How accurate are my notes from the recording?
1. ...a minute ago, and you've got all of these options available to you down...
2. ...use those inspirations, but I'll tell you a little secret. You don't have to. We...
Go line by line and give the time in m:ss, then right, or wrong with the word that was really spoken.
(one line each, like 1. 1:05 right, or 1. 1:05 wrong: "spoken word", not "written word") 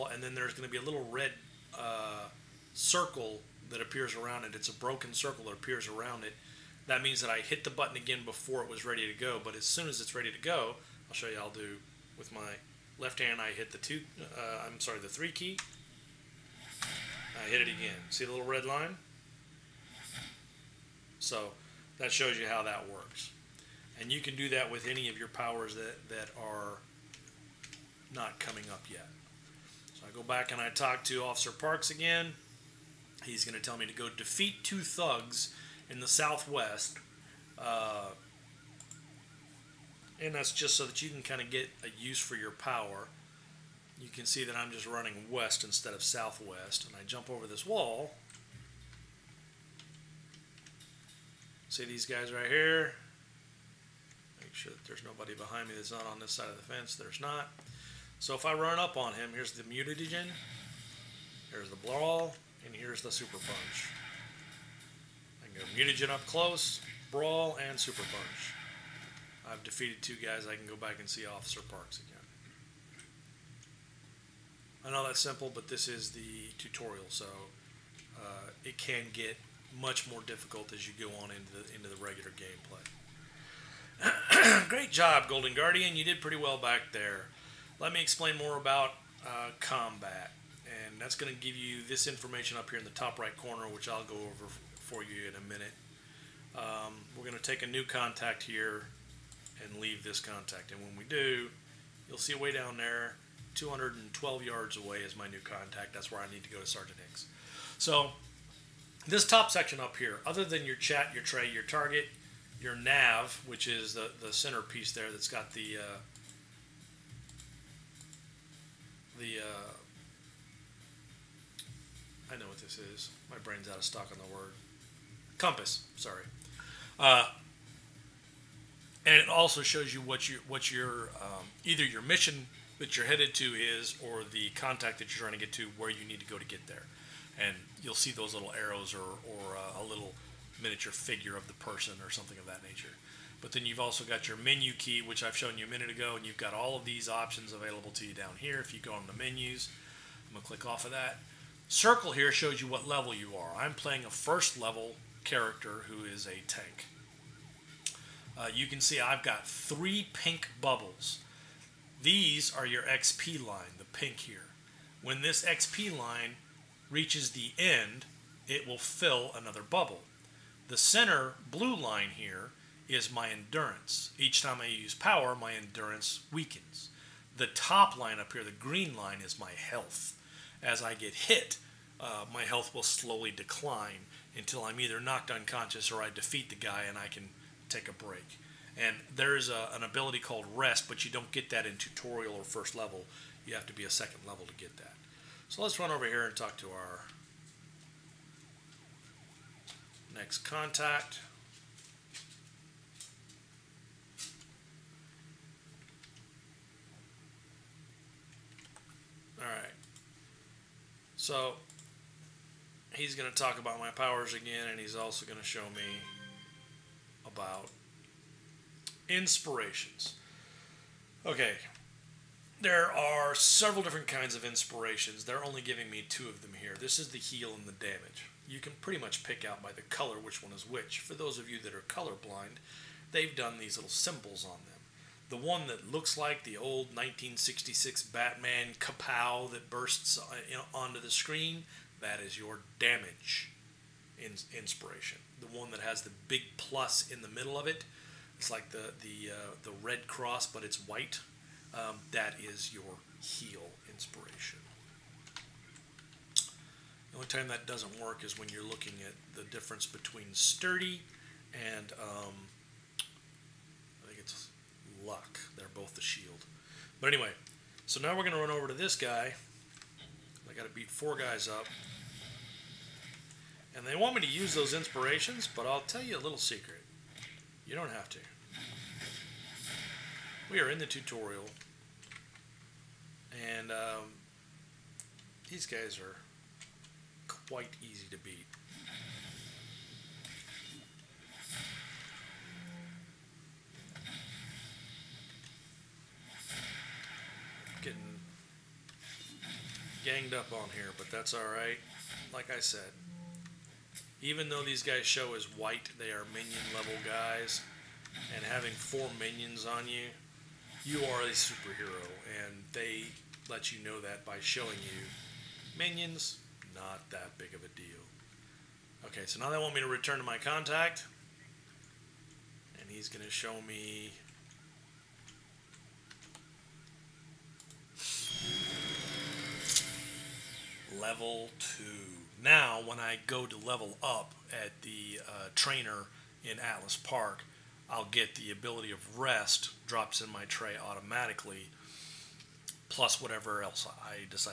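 1. 2:25 right
2. 4:34 right.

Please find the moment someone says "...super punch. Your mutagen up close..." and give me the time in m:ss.
1:03.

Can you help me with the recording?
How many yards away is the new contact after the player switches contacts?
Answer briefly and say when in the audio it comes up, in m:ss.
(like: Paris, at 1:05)
212, at 1:43.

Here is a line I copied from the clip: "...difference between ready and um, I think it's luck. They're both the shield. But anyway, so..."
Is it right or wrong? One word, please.
wrong.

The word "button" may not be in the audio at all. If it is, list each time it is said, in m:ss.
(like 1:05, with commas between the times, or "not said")
0:07.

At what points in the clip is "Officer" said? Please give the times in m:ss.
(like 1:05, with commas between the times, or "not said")
0:31, 1:11.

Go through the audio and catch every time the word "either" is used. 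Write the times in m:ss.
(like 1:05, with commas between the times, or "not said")
2:11, 3:04.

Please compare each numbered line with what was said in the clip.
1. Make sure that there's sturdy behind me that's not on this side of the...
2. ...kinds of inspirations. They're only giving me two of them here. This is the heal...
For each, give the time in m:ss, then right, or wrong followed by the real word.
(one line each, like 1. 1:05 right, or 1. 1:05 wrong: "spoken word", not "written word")
1. 0:54 wrong: "nobody", not "sturdy"
2. 3:44 right.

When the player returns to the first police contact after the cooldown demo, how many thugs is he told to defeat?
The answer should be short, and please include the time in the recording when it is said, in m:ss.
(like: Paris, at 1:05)
2, at 0:34.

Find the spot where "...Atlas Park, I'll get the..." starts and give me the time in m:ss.
5:36.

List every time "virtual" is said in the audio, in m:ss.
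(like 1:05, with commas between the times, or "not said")
not said.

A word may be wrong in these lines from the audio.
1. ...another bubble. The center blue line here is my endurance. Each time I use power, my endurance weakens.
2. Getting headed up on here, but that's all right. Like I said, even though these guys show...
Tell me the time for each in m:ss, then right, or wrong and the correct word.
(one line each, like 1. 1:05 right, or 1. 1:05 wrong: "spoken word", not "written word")
1. 2:49 right
2. 4:57 wrong: "ganged", not "headed".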